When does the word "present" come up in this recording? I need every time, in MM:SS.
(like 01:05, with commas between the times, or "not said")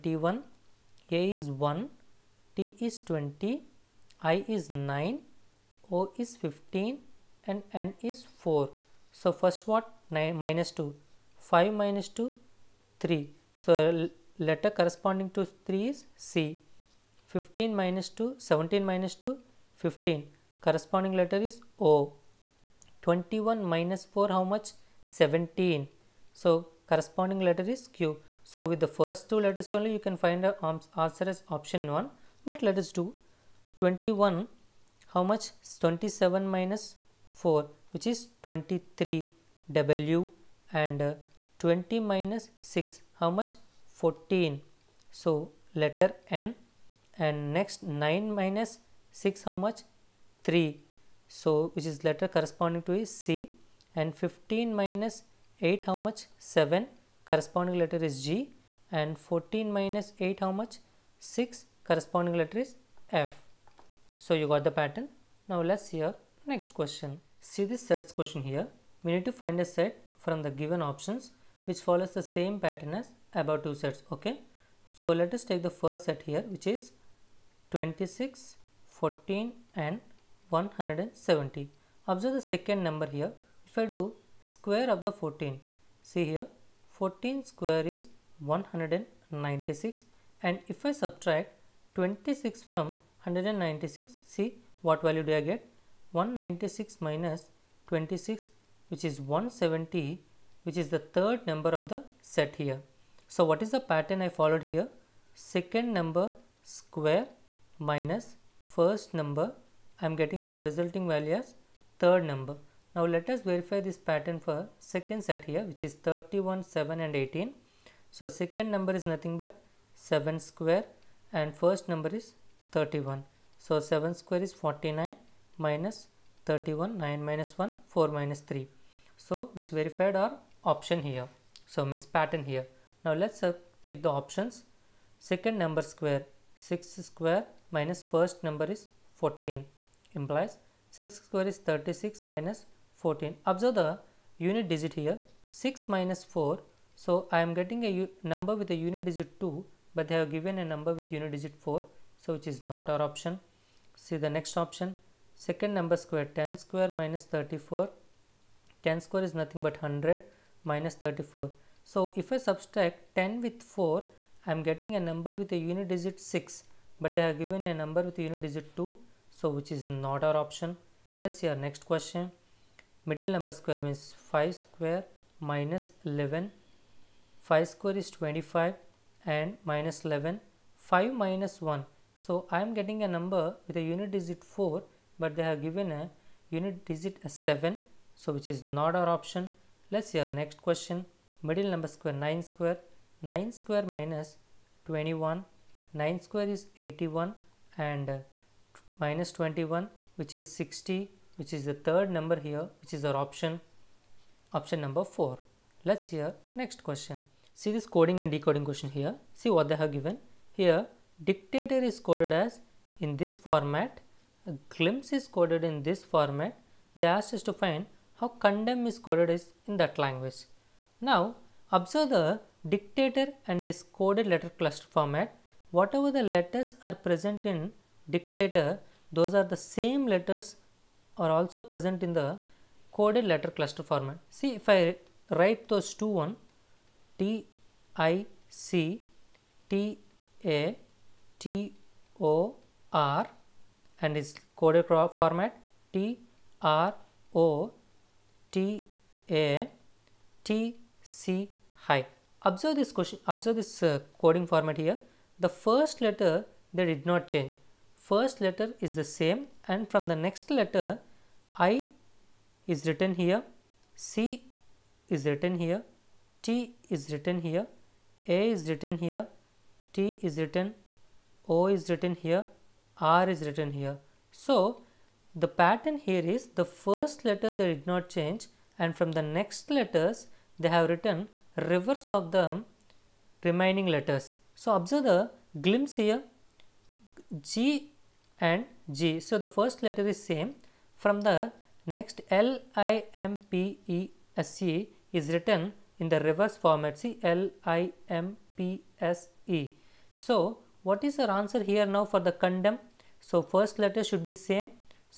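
03:47, 03:51.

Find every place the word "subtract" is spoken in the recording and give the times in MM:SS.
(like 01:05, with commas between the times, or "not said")
01:30, 02:42.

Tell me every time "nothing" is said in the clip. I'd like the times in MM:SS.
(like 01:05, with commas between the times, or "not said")
01:59, 02:39.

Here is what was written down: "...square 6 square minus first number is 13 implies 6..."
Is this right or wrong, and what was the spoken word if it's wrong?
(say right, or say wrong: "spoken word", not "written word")
wrong: "14", not "13".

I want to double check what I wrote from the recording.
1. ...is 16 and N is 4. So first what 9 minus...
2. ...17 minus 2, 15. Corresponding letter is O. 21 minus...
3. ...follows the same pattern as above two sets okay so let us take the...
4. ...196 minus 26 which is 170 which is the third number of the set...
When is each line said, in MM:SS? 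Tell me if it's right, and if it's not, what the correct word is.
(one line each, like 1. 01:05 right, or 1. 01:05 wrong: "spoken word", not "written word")
1. 00:06 wrong: "15", not "16"
2. 00:18 right
3. 01:11 right
4. 01:36 right.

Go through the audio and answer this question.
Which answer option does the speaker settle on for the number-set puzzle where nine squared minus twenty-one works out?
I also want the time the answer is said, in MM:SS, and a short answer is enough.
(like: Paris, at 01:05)
option number 4, at 03:24.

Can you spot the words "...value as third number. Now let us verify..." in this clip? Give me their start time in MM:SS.
01:51.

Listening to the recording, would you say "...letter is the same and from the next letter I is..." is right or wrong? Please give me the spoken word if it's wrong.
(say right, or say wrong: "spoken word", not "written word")
right.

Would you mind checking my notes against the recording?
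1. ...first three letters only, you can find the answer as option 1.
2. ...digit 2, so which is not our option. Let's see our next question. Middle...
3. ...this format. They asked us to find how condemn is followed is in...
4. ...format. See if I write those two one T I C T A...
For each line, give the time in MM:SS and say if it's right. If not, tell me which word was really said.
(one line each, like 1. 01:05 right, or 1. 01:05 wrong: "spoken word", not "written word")
1. 00:28 wrong: "two", not "three"
2. 02:48 right
3. 03:35 wrong: "coded", not "followed"
4. 03:53 right.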